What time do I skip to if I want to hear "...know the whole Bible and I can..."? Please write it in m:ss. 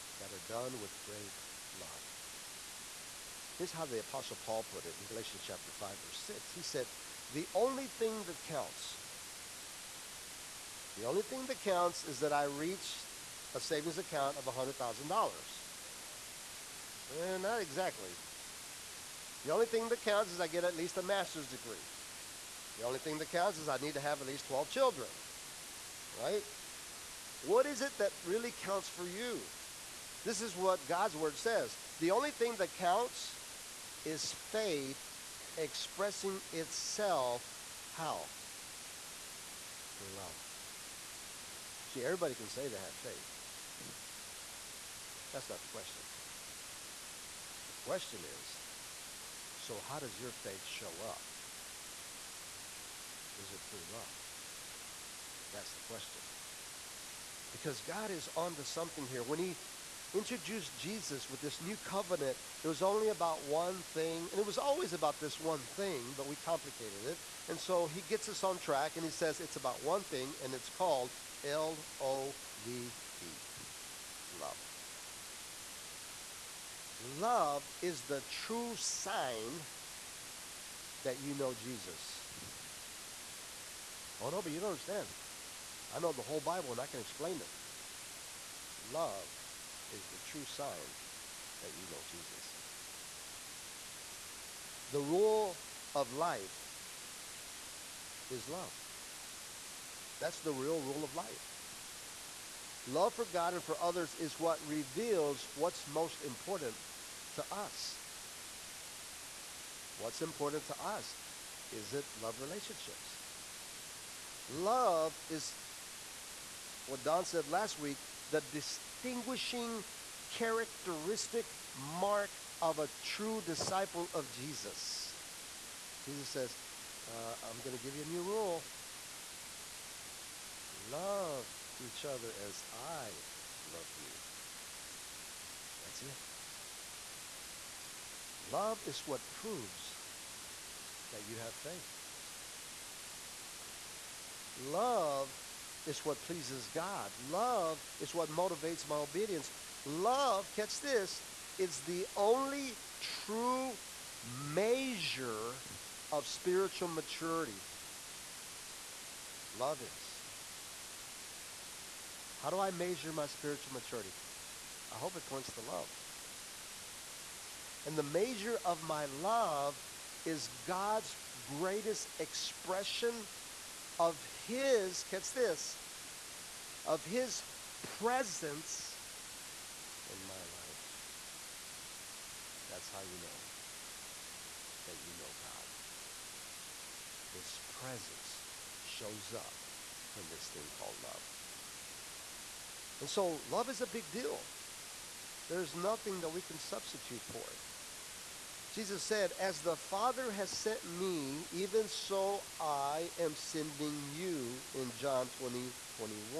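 1:25.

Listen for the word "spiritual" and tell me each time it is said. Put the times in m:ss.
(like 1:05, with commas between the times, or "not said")
2:36, 2:43.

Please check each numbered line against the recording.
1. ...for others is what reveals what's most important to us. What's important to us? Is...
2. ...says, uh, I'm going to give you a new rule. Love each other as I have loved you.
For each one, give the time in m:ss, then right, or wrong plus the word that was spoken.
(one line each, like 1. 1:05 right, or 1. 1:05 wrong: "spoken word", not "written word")
1. 1:43 right
2. 2:06 right.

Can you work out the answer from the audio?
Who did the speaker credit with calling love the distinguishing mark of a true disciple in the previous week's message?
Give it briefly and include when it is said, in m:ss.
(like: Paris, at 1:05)
Don, at 1:57.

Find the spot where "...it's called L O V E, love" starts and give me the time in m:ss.
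1:10.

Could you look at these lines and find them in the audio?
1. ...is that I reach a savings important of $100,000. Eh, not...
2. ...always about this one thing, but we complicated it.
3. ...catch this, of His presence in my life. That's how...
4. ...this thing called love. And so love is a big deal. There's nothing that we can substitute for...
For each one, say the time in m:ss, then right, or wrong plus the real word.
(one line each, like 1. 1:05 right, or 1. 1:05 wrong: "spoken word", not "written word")
1. 0:12 wrong: "account", not "important"
2. 1:04 right
3. 2:55 right
4. 3:10 right.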